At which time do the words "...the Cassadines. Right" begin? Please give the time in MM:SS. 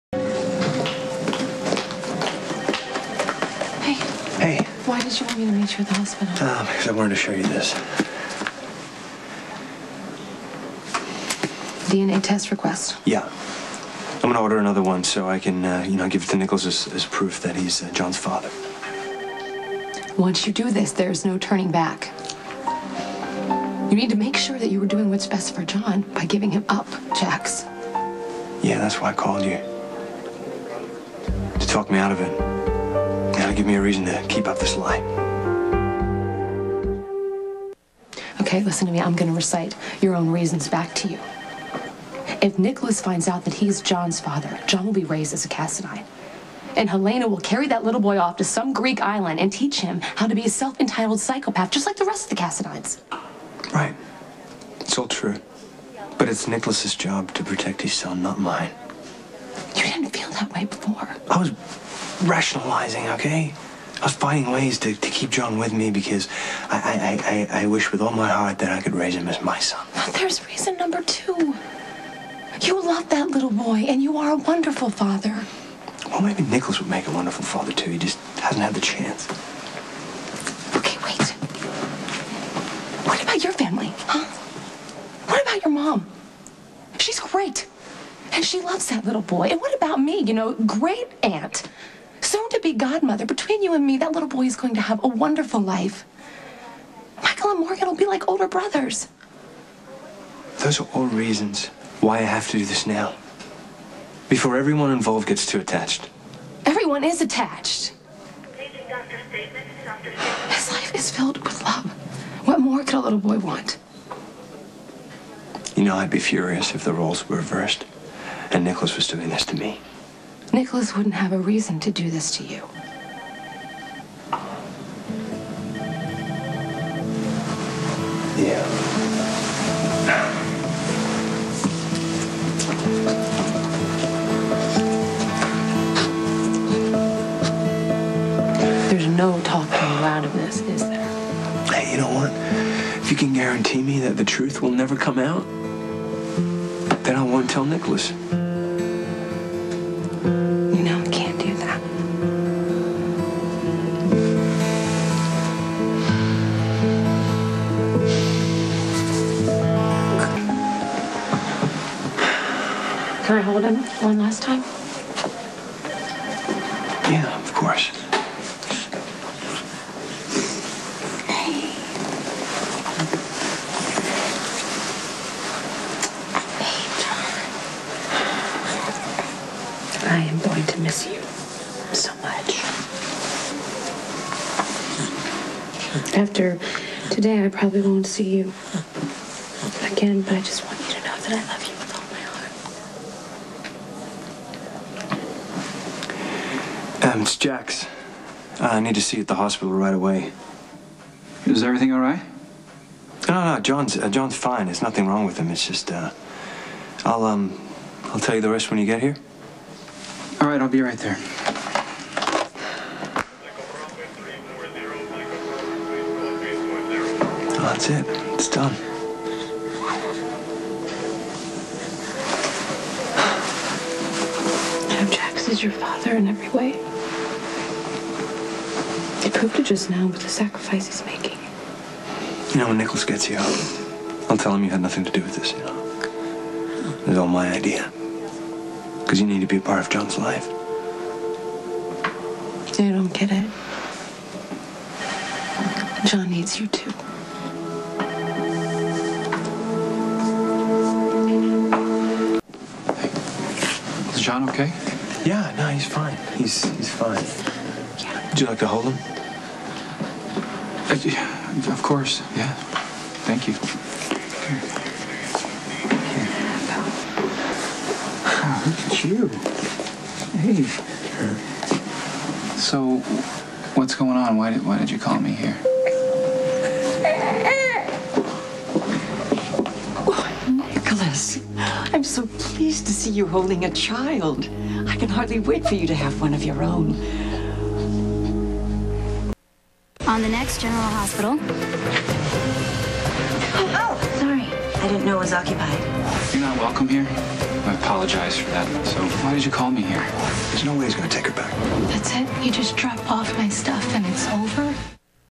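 00:52.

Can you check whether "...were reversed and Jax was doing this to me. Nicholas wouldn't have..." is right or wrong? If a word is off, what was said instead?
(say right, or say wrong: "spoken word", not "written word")
wrong: "Nicholas", not "Jax".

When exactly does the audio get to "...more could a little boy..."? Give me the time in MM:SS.
01:52.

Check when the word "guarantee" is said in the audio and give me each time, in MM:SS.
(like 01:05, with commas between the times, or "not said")
02:23.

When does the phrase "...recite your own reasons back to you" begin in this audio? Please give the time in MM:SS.
00:39.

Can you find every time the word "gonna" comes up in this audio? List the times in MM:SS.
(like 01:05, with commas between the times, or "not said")
00:14, 00:39.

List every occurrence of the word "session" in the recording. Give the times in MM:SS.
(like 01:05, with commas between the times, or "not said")
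not said.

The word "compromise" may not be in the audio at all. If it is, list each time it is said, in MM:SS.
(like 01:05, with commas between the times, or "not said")
not said.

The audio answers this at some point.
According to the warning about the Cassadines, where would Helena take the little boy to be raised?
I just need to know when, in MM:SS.
00:48.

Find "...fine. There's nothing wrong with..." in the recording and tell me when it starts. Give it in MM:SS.
03:24.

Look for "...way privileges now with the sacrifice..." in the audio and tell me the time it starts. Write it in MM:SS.
03:46.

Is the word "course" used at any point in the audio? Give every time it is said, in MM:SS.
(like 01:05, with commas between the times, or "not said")
02:47, 04:21.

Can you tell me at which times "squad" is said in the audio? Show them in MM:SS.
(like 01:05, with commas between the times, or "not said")
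not said.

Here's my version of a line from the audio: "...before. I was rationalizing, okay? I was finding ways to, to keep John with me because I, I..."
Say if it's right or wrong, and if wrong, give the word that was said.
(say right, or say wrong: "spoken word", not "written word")
right.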